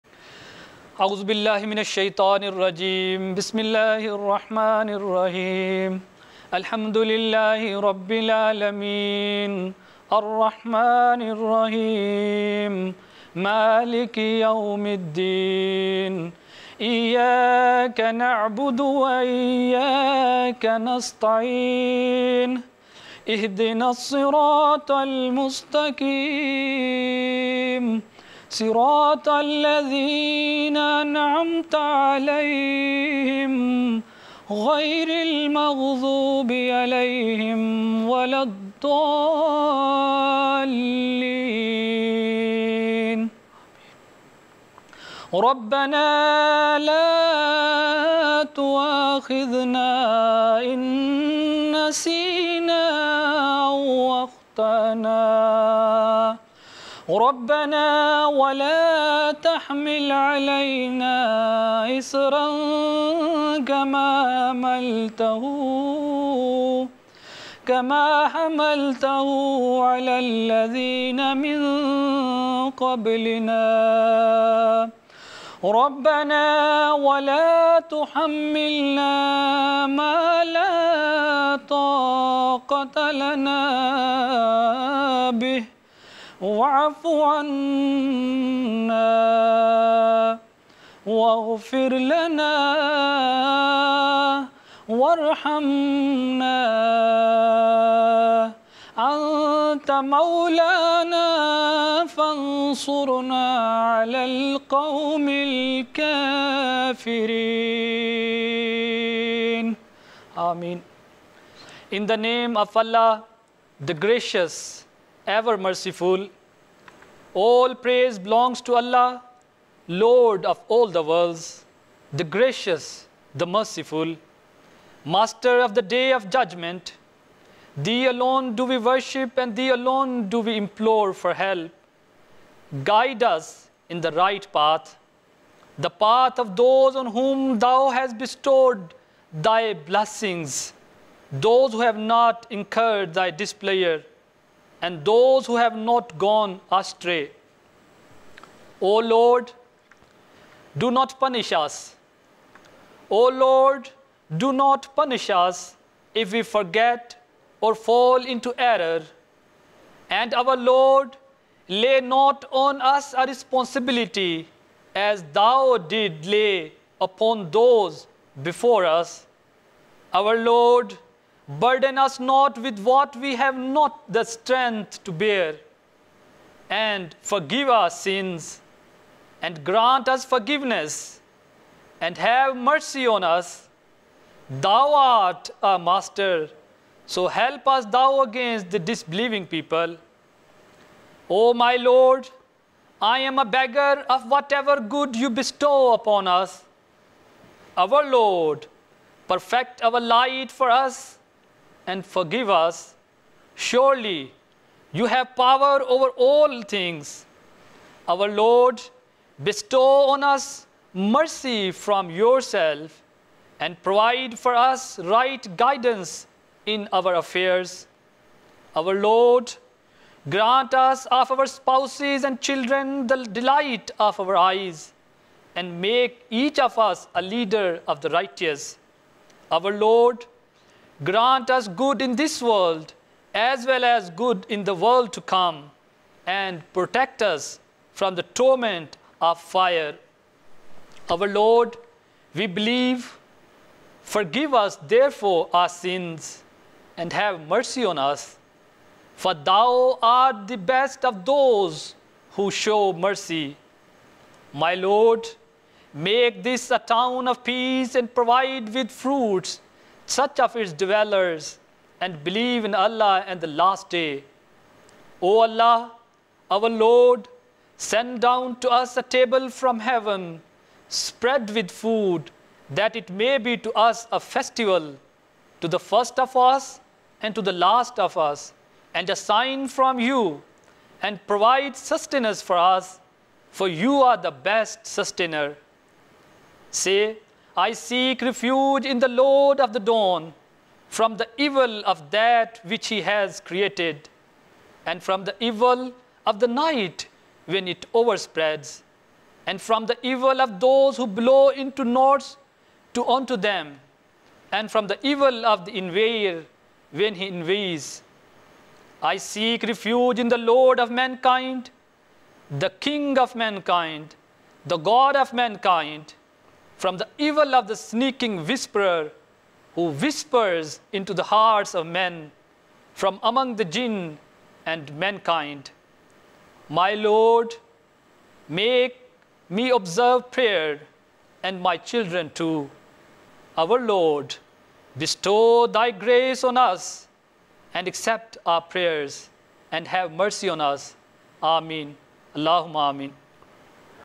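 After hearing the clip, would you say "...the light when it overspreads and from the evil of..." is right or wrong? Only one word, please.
wrong.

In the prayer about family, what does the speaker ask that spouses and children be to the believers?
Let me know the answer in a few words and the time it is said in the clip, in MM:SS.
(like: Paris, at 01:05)
Delight of our eyes, at 03:43.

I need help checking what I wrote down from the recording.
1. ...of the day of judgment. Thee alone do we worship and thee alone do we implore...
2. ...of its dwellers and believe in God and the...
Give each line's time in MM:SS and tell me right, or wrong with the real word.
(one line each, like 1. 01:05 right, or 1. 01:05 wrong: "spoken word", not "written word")
1. 02:05 right
2. 04:20 wrong: "Allah", not "God".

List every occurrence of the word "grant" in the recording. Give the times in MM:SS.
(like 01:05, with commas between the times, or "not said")
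02:59, 03:40, 03:51.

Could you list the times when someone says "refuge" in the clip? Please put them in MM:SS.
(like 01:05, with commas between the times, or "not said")
04:48, 05:09.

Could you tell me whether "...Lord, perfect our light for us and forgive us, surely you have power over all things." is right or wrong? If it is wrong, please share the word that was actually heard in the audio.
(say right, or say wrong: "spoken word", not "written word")
right.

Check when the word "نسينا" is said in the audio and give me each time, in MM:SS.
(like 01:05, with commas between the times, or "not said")
00:51.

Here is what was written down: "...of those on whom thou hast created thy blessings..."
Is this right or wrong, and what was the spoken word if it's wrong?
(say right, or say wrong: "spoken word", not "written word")
wrong: "bestowed", not "created".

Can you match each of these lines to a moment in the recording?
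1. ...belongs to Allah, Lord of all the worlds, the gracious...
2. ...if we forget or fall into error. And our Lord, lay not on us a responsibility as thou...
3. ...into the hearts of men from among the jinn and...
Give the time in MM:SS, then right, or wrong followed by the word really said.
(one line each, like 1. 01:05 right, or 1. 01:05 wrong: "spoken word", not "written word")
1. 01:58 right
2. 02:36 right
3. 05:20 right.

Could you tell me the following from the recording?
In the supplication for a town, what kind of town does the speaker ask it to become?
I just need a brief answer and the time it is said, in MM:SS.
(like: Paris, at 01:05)
A town of peace, at 04:16.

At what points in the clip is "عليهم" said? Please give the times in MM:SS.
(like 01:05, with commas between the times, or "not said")
00:31, 00:36.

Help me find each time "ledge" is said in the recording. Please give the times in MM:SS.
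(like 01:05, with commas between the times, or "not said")
not said.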